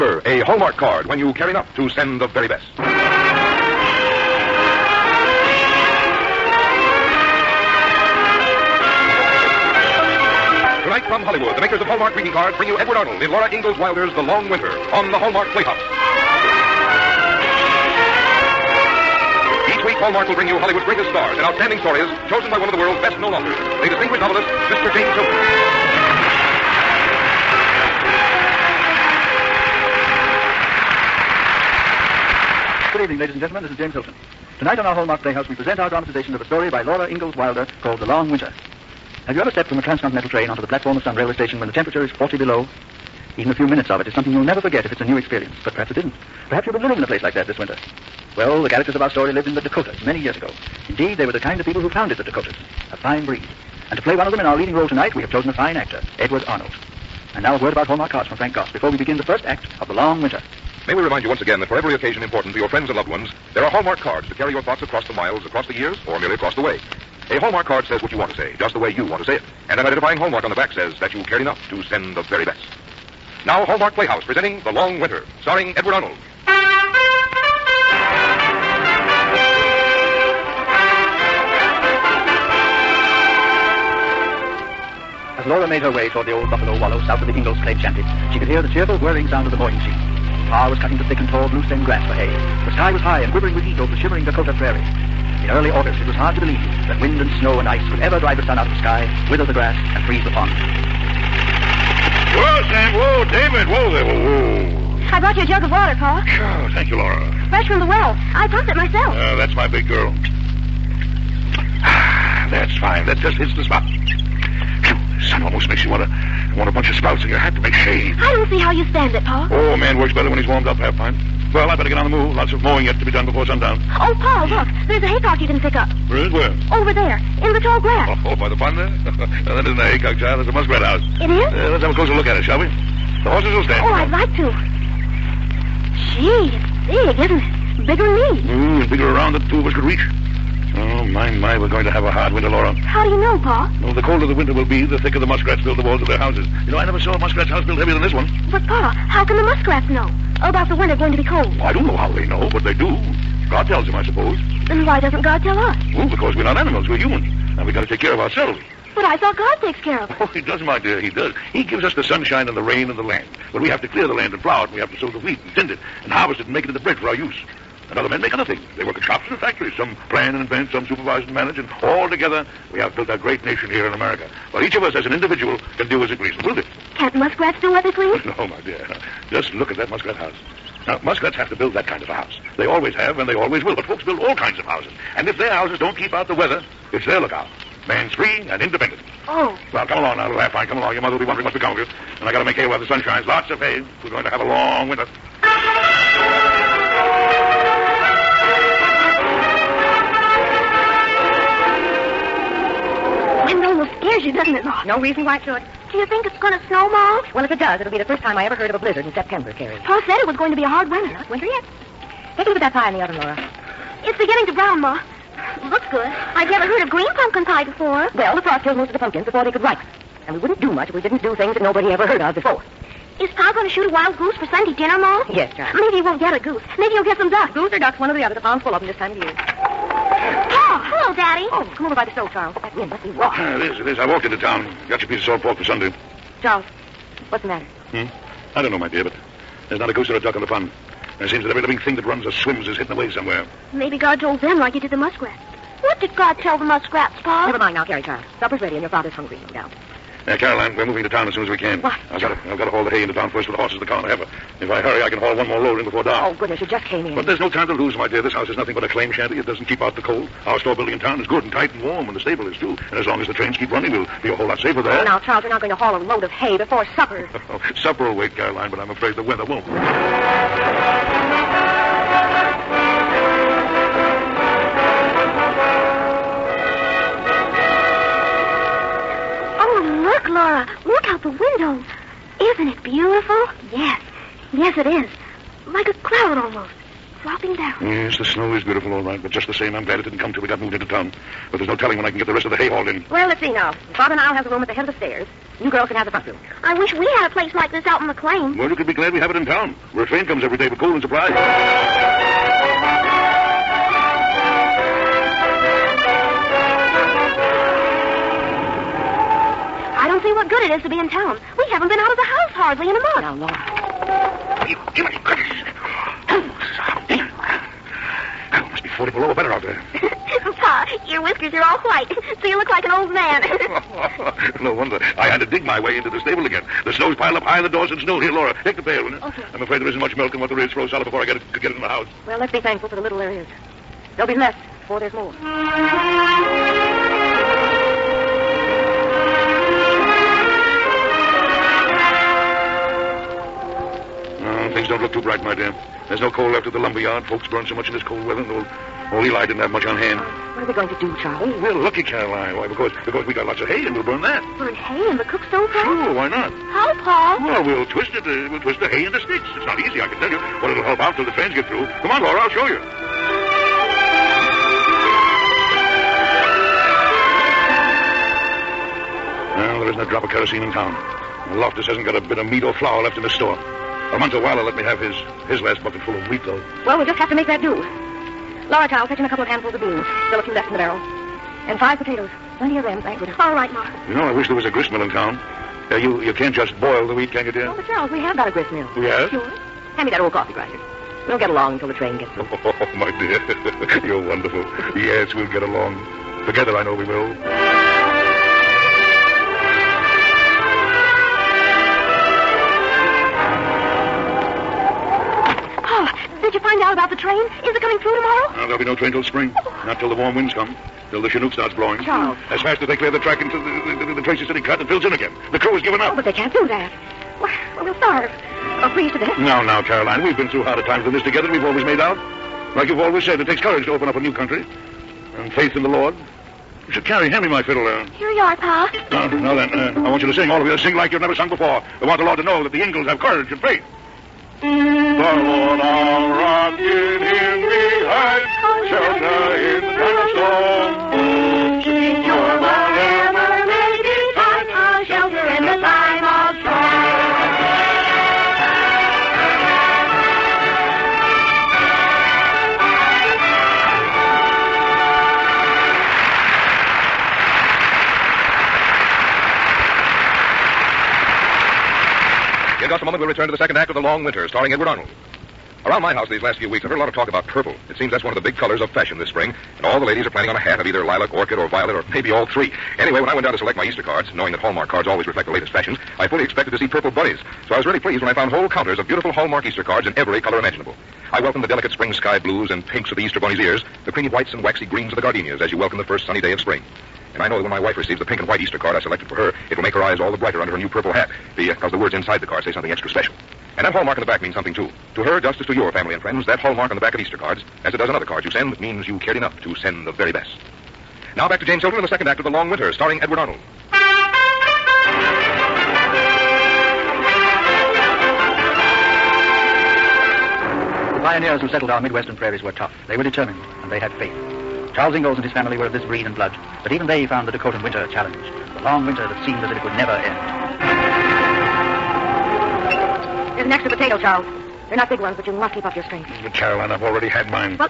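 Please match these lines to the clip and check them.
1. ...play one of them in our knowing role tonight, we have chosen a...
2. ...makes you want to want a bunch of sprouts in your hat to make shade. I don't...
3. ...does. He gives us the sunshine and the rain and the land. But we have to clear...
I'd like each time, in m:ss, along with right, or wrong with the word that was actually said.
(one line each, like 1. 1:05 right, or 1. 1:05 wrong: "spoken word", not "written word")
1. 0:54 wrong: "leading", not "knowing"
2. 1:55 right
3. 2:41 right.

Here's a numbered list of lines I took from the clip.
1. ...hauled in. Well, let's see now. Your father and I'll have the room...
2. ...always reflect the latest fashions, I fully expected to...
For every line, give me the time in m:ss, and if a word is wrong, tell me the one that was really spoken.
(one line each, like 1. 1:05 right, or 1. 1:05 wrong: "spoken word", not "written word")
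1. 4:52 right
2. 7:55 right.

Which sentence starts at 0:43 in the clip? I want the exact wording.
Even a few minutes of it is something you'll never forget if it's a new experience, but perhaps it isn't.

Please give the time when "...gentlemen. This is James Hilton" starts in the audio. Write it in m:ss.
0:33.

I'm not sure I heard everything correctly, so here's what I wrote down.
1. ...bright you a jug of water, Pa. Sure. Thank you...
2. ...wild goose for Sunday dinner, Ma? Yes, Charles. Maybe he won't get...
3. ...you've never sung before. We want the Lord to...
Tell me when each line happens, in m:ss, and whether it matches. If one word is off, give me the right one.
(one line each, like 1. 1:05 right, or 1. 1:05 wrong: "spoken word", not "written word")
1. 1:45 wrong: "brought", not "bright"
2. 3:43 right
3. 7:11 right.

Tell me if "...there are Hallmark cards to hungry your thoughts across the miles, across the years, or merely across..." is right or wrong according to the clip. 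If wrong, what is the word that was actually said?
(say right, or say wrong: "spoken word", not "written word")
wrong: "carry", not "hungry".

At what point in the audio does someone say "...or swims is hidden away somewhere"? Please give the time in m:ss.
4:02.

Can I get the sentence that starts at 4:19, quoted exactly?
It doesn't keep out the cold.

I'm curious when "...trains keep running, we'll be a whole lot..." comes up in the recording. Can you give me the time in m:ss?
4:23.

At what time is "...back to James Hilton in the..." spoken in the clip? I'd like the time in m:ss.
8:21.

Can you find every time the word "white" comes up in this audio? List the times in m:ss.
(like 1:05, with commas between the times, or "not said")
5:21, 8:04, 8:08.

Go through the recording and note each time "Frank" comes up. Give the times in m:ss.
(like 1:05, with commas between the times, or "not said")
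0:58.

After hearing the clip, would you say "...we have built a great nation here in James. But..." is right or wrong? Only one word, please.
wrong.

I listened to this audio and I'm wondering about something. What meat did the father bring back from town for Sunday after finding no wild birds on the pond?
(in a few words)
Salt pork.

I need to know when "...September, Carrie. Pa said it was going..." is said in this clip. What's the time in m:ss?
3:29.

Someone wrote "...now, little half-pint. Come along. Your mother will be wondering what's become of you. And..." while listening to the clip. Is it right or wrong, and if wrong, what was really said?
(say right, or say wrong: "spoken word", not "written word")
right.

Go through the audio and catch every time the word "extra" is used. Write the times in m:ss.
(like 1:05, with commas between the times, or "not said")
8:12, 8:43.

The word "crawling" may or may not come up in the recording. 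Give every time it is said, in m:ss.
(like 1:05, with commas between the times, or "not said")
not said.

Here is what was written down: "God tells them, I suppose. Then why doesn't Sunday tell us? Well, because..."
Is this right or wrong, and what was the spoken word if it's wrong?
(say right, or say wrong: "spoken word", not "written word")
wrong: "God", not "Sunday".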